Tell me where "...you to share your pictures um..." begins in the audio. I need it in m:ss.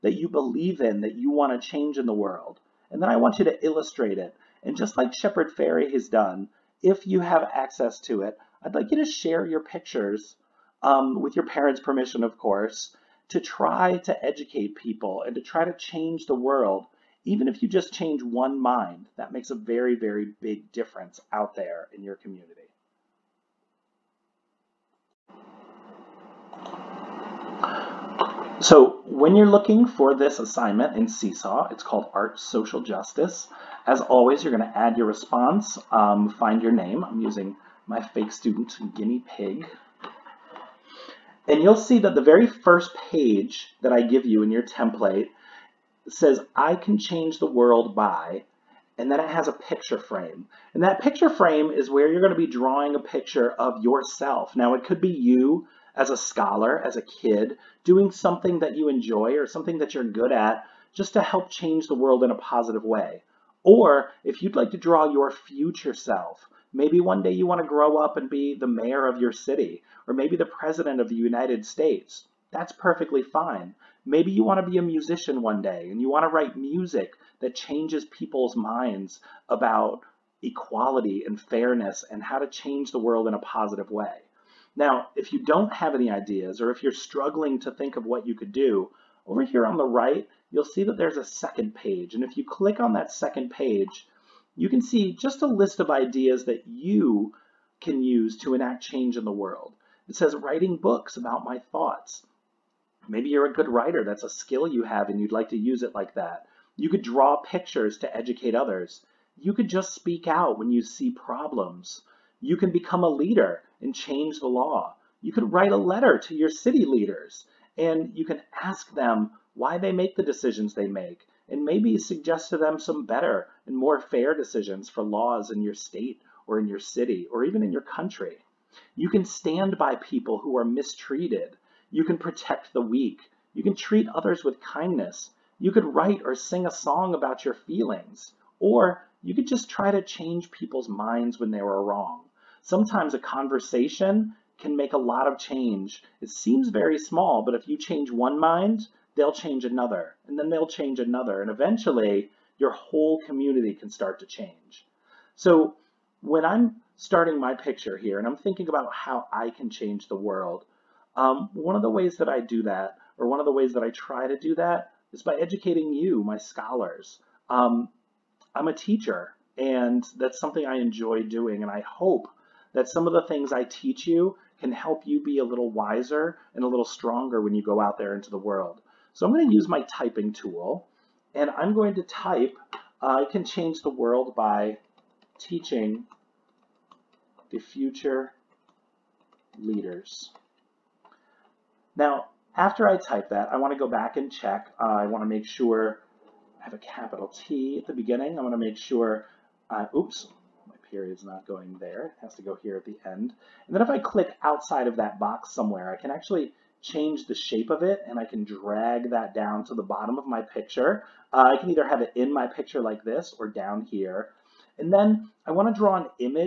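0:08.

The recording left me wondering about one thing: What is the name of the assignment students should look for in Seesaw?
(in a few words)
Art Social Justice.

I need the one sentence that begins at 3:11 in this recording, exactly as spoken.
Now, after I type that, I want to go back and check.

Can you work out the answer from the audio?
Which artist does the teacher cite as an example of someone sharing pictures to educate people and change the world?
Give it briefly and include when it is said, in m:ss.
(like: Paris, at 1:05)
Shepard Fairey, at 0:05.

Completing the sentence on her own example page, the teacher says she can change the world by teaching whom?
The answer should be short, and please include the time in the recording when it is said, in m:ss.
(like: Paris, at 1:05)
the future leaders, at 3:07.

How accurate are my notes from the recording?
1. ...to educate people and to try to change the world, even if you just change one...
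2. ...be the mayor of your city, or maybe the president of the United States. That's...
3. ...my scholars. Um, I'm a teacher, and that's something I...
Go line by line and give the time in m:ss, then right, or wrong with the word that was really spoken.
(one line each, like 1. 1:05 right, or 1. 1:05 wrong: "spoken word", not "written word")
1. 0:13 right
2. 1:08 right
3. 2:46 right.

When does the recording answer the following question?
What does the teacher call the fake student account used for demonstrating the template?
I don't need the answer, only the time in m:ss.
0:38.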